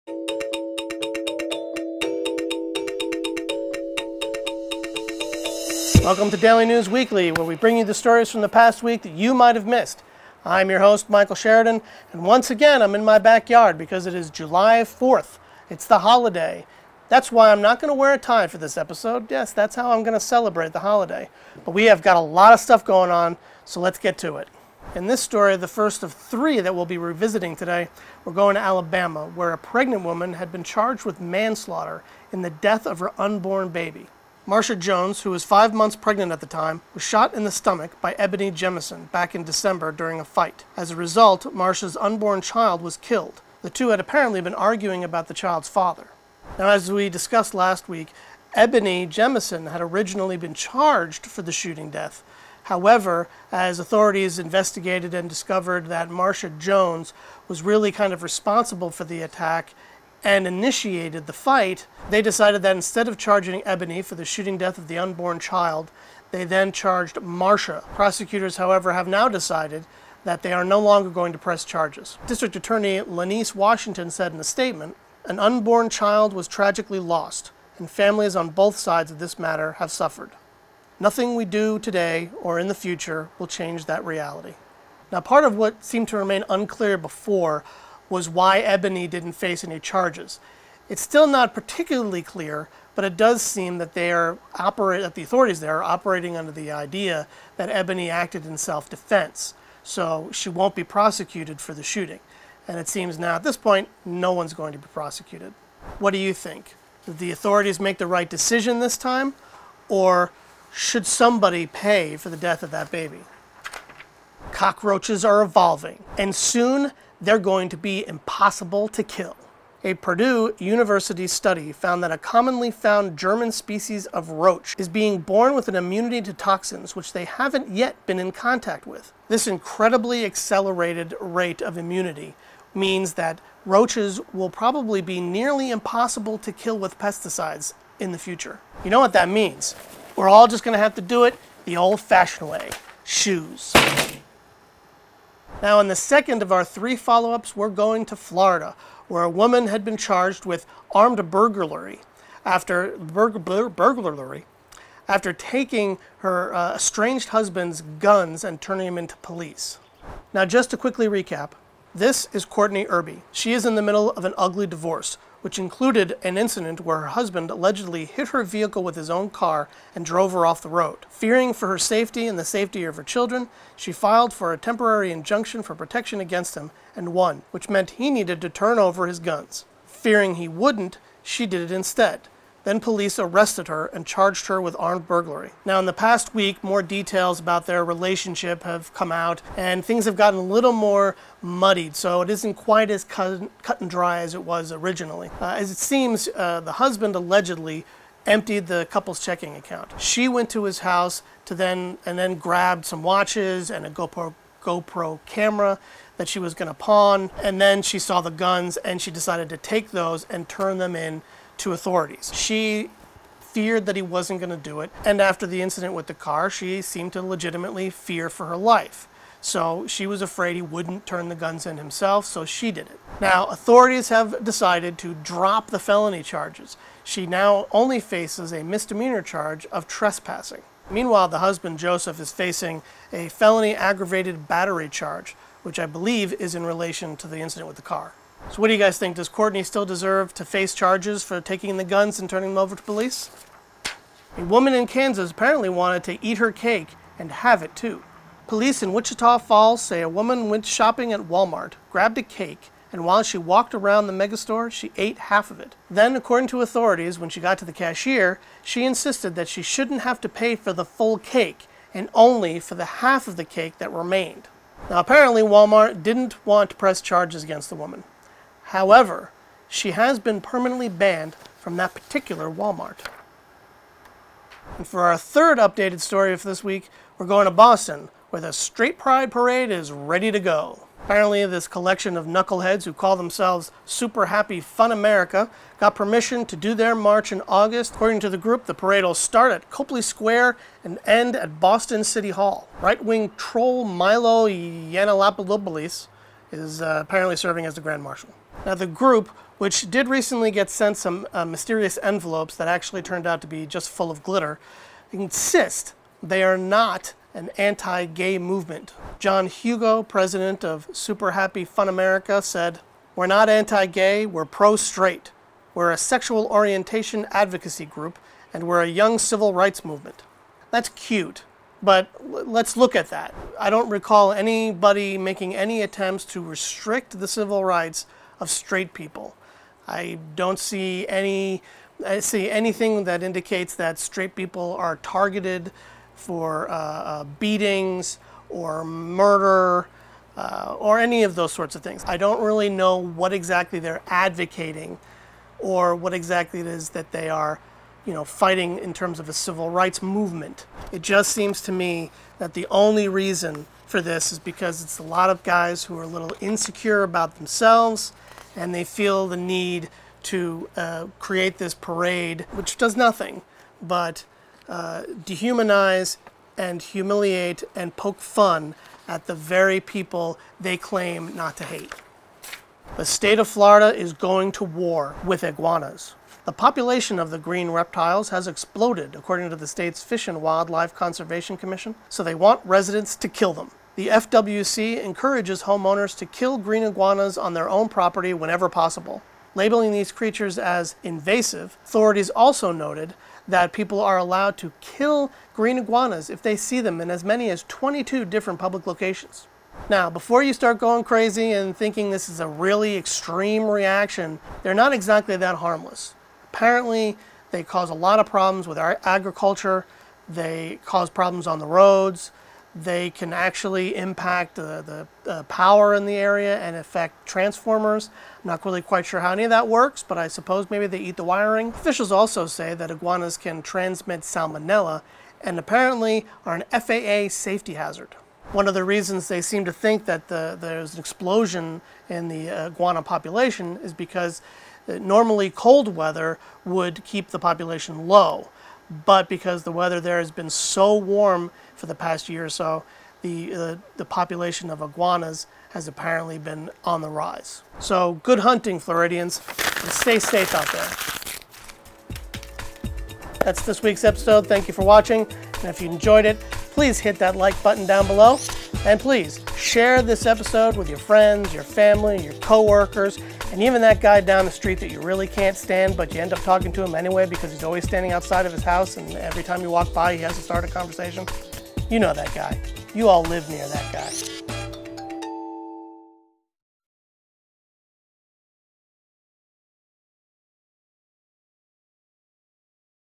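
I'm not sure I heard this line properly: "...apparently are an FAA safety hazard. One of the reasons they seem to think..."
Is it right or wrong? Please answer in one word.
right.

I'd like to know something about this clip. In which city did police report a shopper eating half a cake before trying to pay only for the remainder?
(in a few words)
Wichita Falls.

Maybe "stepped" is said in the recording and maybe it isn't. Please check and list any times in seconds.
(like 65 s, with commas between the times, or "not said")
not said.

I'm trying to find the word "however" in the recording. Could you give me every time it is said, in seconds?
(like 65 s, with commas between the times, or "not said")
52 s, 68 s, 268 s.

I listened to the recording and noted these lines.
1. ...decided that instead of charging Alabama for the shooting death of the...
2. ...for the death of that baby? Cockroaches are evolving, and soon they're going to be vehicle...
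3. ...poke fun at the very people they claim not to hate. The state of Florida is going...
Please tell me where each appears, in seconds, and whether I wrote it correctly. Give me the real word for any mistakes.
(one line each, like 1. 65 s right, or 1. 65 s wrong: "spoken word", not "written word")
1. 62 s wrong: "Ebony", not "Alabama"
2. 112 s wrong: "impossible", not "vehicle"
3. 367 s right.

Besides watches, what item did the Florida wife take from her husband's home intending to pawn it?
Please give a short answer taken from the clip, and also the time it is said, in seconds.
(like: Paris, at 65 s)
GoPro camera, at 203 s.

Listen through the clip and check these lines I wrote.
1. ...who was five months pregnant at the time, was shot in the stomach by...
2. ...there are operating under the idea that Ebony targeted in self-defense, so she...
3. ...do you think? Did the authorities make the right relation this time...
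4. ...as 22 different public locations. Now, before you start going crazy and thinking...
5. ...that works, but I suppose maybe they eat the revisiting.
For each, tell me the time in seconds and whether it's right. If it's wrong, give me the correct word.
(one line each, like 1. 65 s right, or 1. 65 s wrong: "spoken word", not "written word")
1. 35 s right
2. 95 s wrong: "acted", not "targeted"
3. 106 s wrong: "decision", not "relation"
4. 397 s right
5. 419 s wrong: "wiring", not "revisiting".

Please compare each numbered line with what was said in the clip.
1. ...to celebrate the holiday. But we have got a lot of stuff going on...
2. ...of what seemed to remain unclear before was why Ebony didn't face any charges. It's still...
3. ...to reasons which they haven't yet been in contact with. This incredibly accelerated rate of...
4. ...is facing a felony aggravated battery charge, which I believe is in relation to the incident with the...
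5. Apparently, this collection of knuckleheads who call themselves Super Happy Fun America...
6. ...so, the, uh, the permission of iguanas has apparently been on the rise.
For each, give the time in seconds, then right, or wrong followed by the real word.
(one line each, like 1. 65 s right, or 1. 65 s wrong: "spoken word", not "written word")
1. 20 s right
2. 85 s right
3. 126 s wrong: "toxins", not "reasons"
4. 232 s right
5. 281 s right
6. 442 s wrong: "population", not "permission".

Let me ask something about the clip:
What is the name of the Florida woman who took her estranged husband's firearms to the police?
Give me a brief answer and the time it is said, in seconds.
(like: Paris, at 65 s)
Courtney Irby, at 162 s.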